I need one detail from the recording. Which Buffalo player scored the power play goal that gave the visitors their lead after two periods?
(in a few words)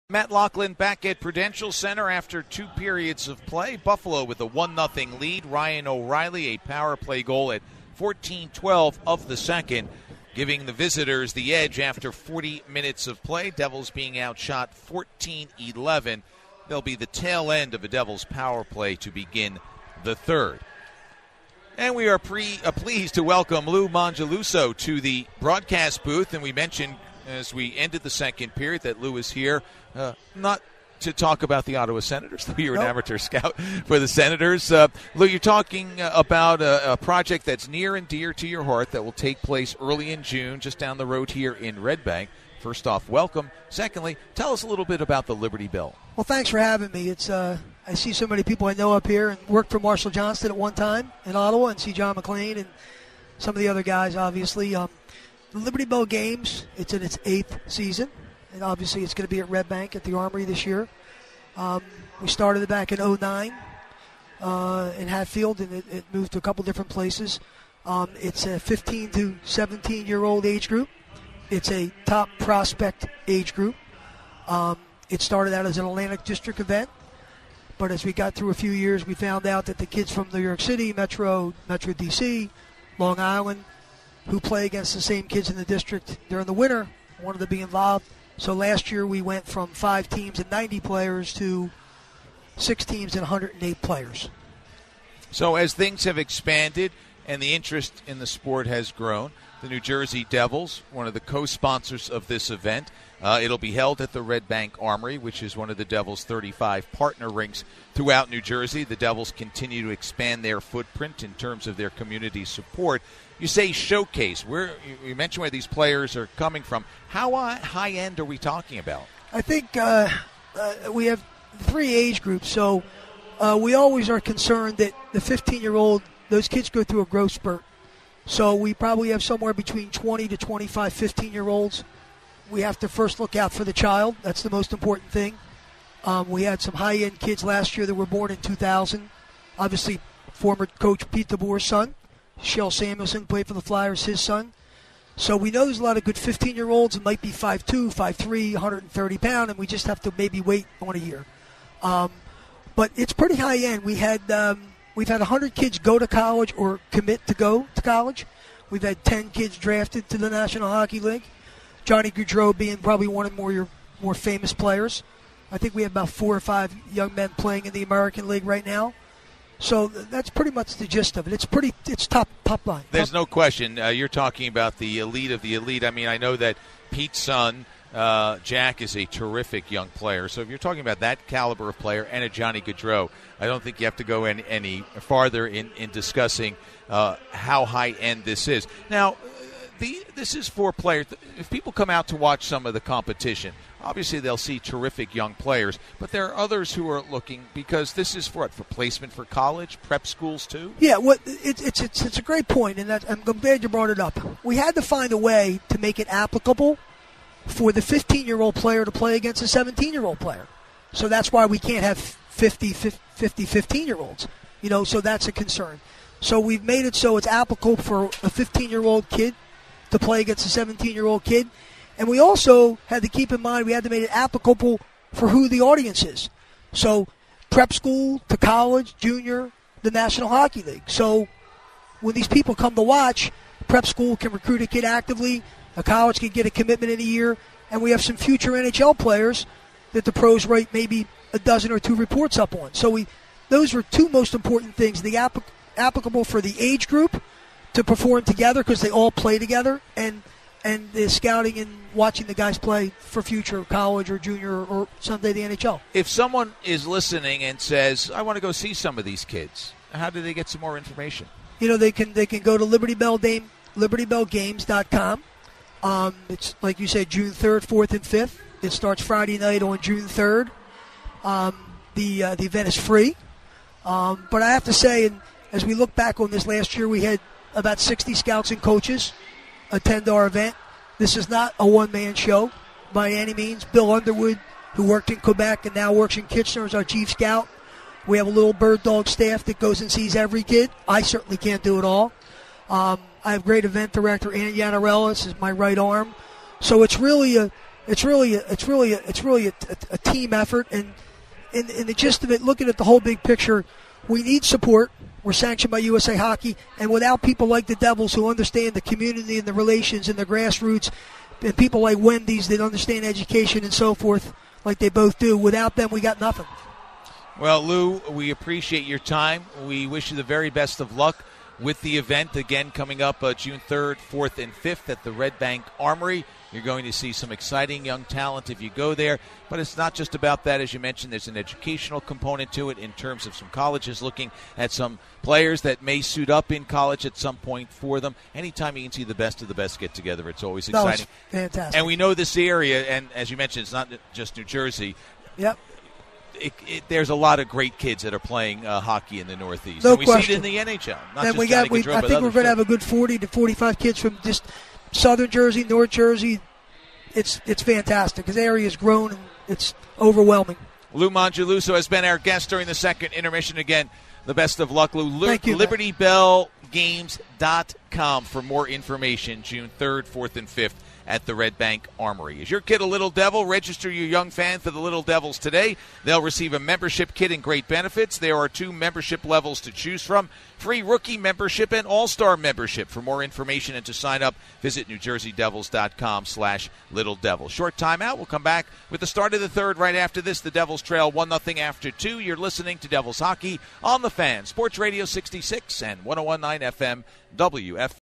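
Ryan O'Reilly.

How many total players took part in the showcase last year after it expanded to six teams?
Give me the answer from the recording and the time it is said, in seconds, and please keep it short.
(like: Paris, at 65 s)
108, at 93 s.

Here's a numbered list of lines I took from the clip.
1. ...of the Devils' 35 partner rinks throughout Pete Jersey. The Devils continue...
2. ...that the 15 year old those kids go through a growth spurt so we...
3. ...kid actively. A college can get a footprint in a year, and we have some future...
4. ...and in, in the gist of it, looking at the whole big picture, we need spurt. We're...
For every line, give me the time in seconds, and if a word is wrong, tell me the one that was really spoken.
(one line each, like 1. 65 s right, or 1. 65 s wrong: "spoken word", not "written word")
1. 105 s wrong: "New", not "Pete"
2. 124 s right
3. 234 s wrong: "commitment", not "footprint"
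4. 300 s wrong: "support", not "spurt".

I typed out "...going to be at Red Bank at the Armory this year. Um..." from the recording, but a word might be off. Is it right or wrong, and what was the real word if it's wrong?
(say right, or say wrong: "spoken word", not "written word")
right.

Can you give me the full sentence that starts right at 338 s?
Anytime you can see the best of the best get together, it's always exciting.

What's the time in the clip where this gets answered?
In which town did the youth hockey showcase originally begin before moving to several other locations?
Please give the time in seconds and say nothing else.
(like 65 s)
65 s.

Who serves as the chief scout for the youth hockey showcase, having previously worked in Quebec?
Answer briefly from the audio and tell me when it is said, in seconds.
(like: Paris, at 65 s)
Bill Underwood, at 283 s.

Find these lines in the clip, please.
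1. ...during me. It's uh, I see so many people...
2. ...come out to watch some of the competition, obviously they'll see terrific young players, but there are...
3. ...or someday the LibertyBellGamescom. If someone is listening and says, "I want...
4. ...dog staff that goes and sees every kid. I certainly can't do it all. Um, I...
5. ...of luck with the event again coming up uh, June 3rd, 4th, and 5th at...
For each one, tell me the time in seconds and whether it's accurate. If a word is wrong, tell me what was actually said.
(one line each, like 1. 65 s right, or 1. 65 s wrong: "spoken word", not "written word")
1. 46 s wrong: "having", not "during"
2. 191 s right
3. 254 s wrong: "NHL", not "LibertyBellGamescom"
4. 288 s right
5. 320 s right.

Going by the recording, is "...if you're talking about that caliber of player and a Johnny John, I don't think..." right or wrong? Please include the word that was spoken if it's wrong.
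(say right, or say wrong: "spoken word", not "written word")
wrong: "Gaudreau", not "John".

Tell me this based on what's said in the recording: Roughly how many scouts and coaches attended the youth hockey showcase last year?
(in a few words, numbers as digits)
60.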